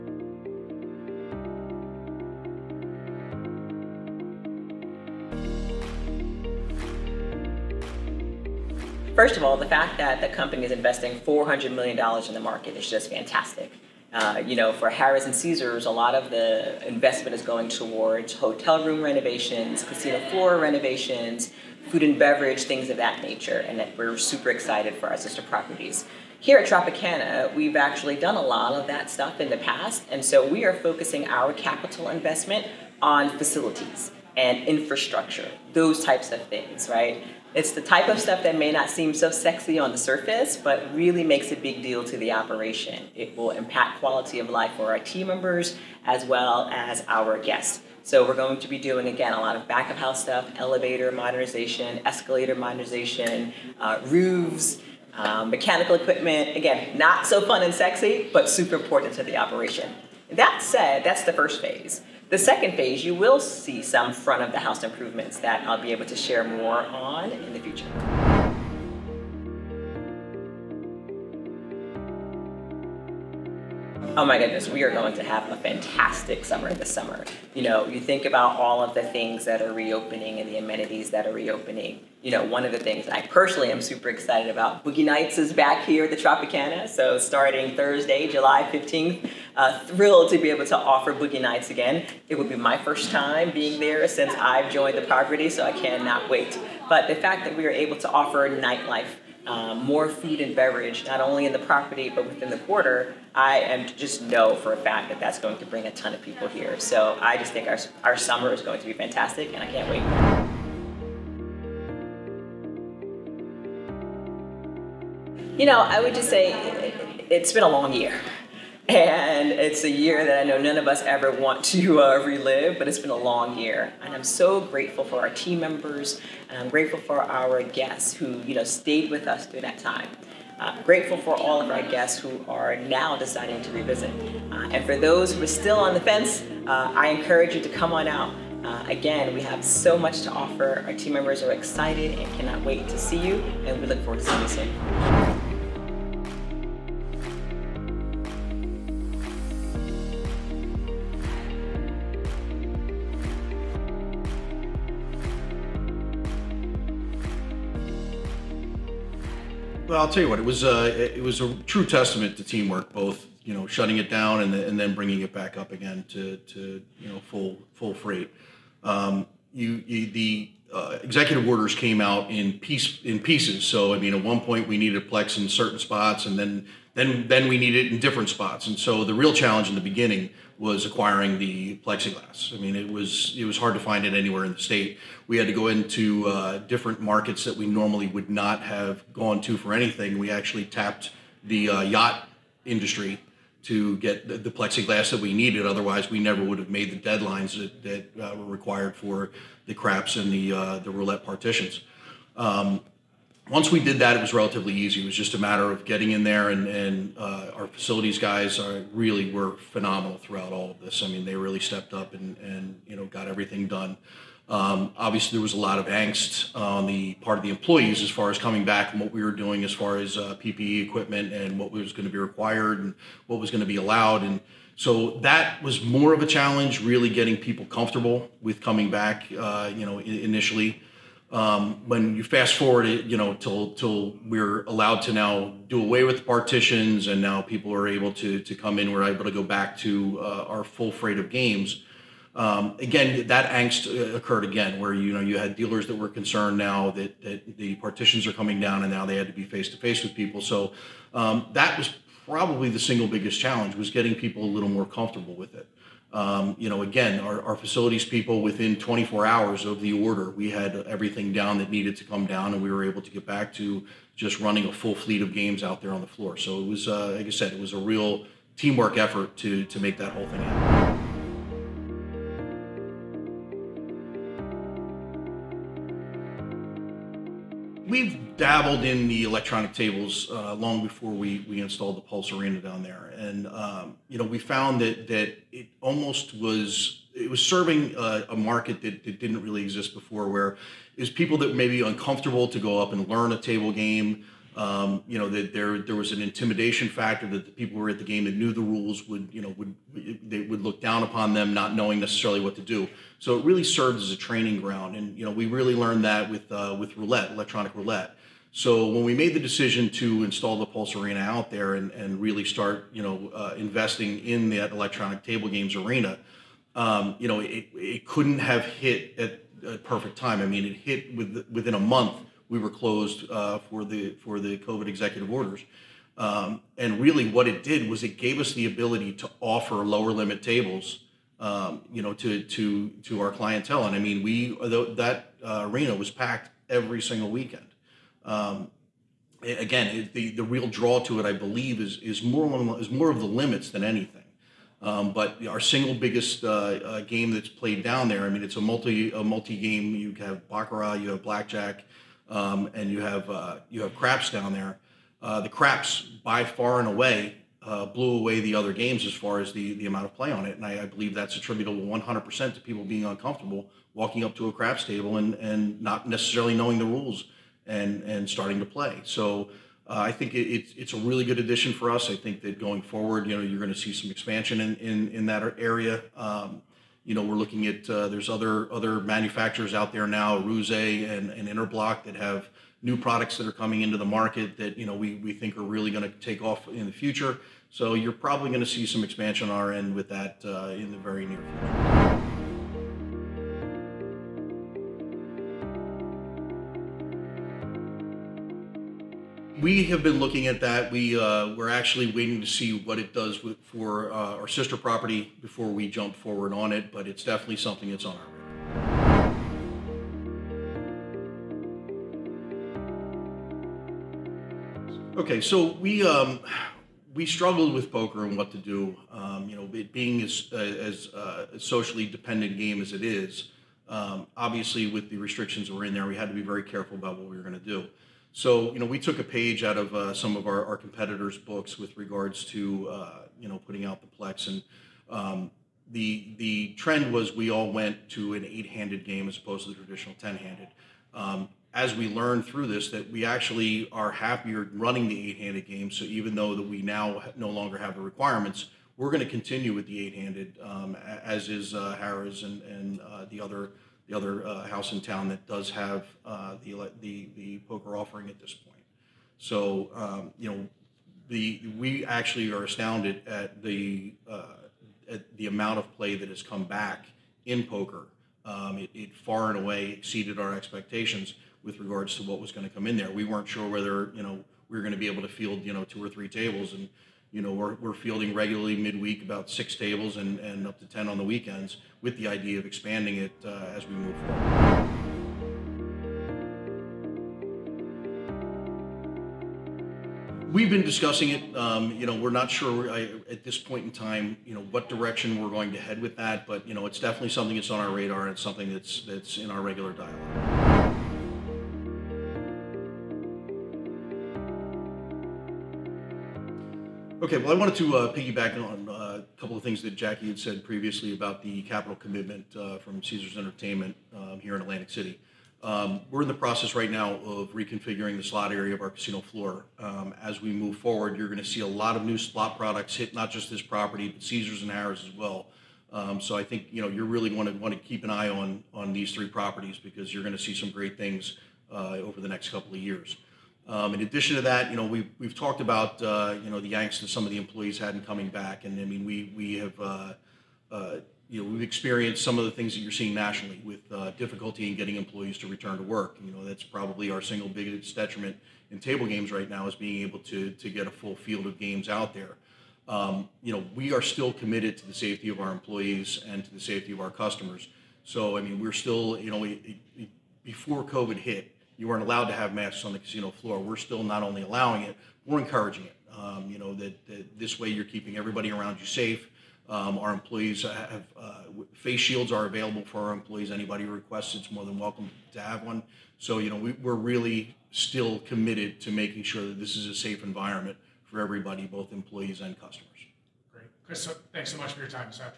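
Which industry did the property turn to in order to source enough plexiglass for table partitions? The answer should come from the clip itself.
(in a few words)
yacht industry.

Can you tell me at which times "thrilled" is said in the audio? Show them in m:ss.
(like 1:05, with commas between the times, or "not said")
1:29.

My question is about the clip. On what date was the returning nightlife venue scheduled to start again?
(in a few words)
July 15.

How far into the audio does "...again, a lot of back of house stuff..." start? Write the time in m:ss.
0:49.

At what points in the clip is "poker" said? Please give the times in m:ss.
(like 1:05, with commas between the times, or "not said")
6:57, 7:37, 7:47.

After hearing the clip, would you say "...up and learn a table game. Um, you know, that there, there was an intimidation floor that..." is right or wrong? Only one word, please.
wrong.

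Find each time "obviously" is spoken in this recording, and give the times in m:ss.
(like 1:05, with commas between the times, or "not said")
3:34, 7:04.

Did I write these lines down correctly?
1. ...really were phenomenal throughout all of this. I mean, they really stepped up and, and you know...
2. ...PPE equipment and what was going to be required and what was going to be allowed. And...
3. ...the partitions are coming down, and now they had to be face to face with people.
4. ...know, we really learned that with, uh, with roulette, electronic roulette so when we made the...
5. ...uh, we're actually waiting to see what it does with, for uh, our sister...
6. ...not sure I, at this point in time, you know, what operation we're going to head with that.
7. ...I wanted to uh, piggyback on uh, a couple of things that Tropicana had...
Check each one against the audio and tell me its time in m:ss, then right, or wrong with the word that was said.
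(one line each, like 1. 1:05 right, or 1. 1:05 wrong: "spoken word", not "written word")
1. 3:28 right
2. 3:40 right
3. 4:07 right
4. 5:05 right
5. 6:41 right
6. 8:12 wrong: "direction", not "operation"
7. 8:27 wrong: "Jackie", not "Tropicana".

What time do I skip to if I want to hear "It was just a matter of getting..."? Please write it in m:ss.
3:25.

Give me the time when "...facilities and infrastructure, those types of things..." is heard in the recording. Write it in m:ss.
0:33.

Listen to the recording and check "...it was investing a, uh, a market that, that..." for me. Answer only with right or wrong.
wrong.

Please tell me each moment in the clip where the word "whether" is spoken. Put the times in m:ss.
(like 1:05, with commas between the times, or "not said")
7:53.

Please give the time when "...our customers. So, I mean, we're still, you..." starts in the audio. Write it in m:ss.
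9:17.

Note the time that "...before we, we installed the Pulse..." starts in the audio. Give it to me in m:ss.
4:40.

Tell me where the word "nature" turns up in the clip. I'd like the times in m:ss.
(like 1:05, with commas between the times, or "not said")
0:23.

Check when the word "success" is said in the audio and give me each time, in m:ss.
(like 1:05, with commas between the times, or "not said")
not said.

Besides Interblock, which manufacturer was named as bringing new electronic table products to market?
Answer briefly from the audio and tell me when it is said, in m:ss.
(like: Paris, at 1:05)
Aruze, at 6:20.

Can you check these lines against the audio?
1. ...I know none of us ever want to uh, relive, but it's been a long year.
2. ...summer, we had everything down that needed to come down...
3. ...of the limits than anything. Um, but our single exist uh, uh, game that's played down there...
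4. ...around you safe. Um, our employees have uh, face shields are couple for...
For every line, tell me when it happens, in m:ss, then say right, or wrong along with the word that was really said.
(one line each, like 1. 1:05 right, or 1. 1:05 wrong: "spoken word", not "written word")
1. 2:00 right
2. 4:20 wrong: "order", not "summer"
3. 5:43 wrong: "biggest", not "exist"
4. 9:28 wrong: "available", not "couple".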